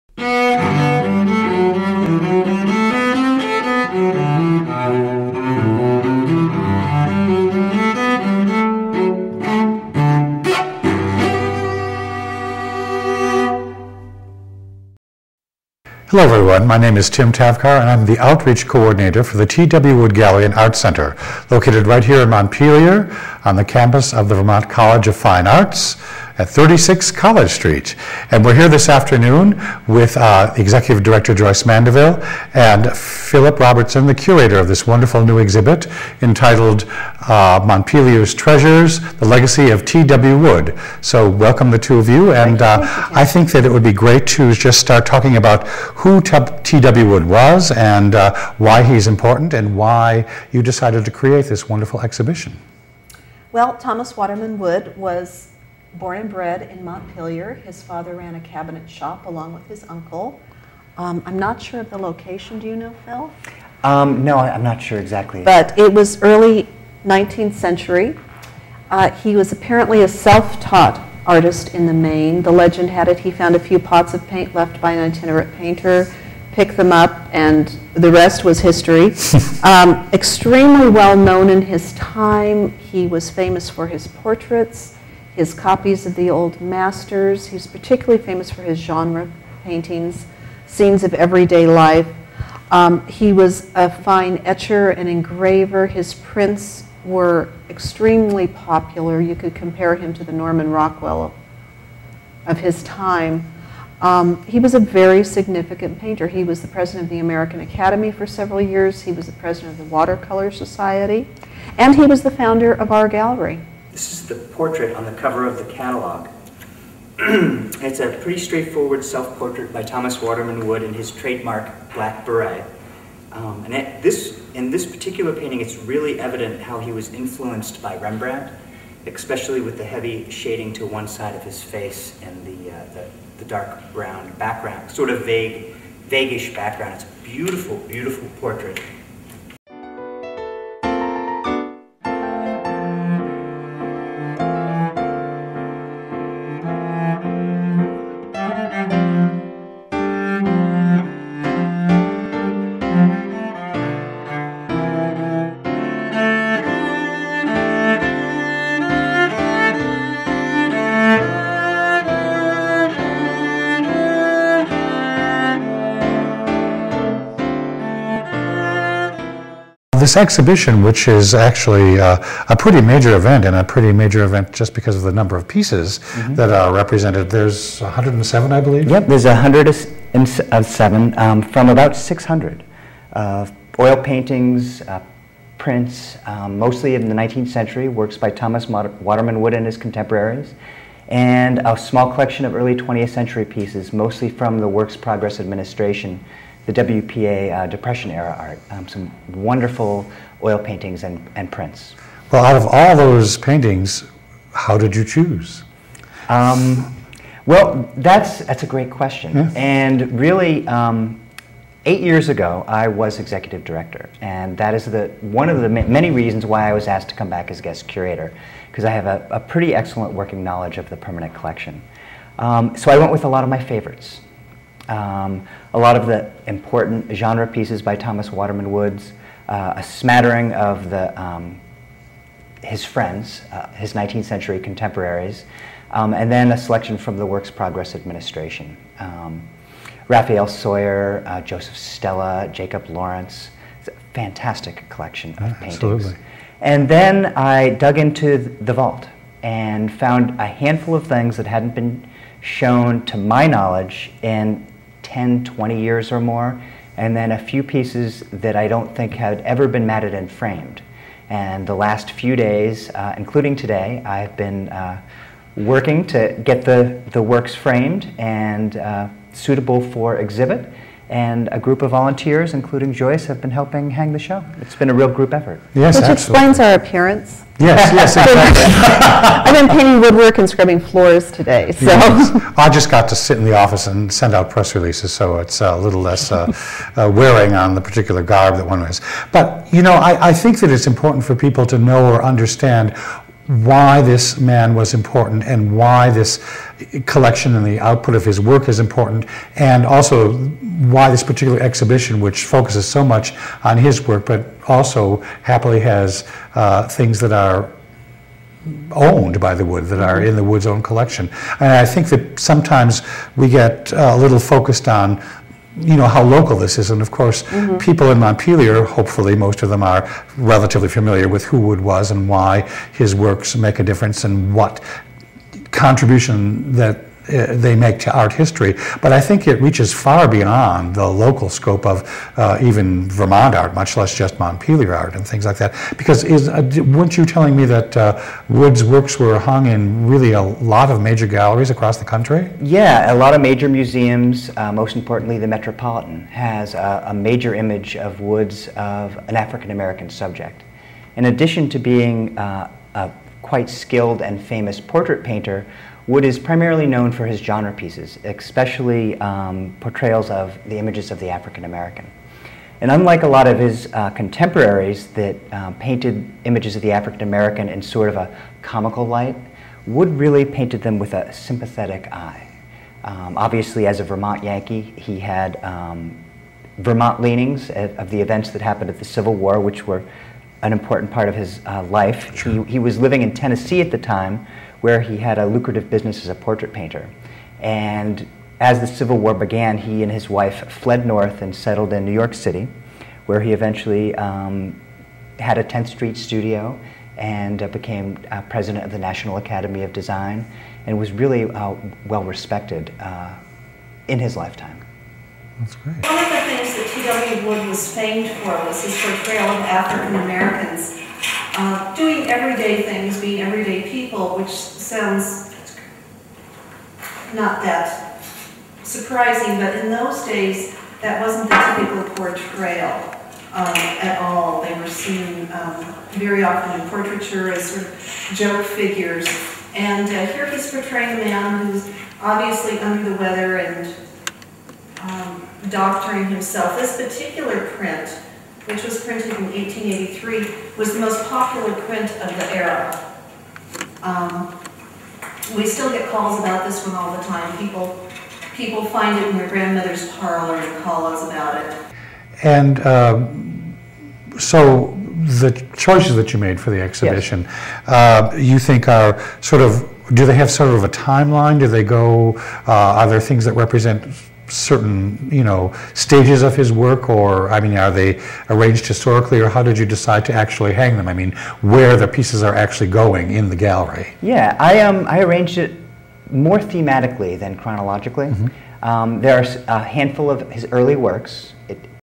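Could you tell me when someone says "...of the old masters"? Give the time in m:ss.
1:26.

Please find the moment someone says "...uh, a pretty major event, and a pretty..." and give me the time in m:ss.
2:51.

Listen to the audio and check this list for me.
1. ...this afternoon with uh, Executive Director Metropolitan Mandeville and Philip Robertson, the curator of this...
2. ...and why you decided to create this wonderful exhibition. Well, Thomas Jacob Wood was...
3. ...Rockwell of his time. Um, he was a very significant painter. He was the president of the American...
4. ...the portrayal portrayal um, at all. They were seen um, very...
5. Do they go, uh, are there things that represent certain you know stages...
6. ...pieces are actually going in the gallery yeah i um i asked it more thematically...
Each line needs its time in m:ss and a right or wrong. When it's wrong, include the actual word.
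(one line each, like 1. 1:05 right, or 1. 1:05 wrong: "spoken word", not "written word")
1. 0:28 wrong: "Joyce", not "Metropolitan"
2. 0:49 wrong: "Waterman", not "Jacob"
3. 1:40 right
4. 7:01 wrong: "typical", not "portrayal"
5. 7:41 right
6. 7:52 wrong: "arranged", not "asked".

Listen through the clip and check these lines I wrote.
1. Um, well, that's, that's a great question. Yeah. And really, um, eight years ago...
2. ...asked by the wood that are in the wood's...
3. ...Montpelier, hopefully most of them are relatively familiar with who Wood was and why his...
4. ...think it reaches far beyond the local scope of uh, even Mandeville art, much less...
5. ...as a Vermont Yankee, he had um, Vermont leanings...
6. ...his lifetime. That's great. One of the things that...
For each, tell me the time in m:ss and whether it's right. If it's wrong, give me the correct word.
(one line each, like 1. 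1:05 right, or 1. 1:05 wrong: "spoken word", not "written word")
1. 3:26 right
2. 5:08 wrong: "owned", not "asked"
3. 5:18 right
4. 5:29 wrong: "Vermont", not "Mandeville"
5. 6:13 right
6. 6:44 right.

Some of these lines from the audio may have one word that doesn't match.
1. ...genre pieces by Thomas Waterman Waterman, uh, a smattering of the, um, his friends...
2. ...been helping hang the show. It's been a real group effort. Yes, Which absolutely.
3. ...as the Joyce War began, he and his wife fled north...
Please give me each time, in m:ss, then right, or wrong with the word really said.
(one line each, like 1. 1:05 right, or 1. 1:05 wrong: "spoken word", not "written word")
1. 3:47 wrong: "Woods", not "Waterman"
2. 4:33 right
3. 6:28 wrong: "Civil", not "Joyce".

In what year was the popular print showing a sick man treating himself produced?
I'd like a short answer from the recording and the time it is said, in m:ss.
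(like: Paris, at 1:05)
1883, at 7:19.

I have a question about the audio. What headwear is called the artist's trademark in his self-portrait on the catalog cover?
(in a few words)
black beret.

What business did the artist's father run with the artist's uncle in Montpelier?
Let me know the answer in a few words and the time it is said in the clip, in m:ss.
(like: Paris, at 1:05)
cabinet shop, at 0:58.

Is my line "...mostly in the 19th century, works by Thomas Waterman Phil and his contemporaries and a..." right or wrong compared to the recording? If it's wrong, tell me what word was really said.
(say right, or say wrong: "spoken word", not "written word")
wrong: "Wood", not "Phil".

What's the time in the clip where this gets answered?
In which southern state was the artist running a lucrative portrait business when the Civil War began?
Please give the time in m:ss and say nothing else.
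6:23.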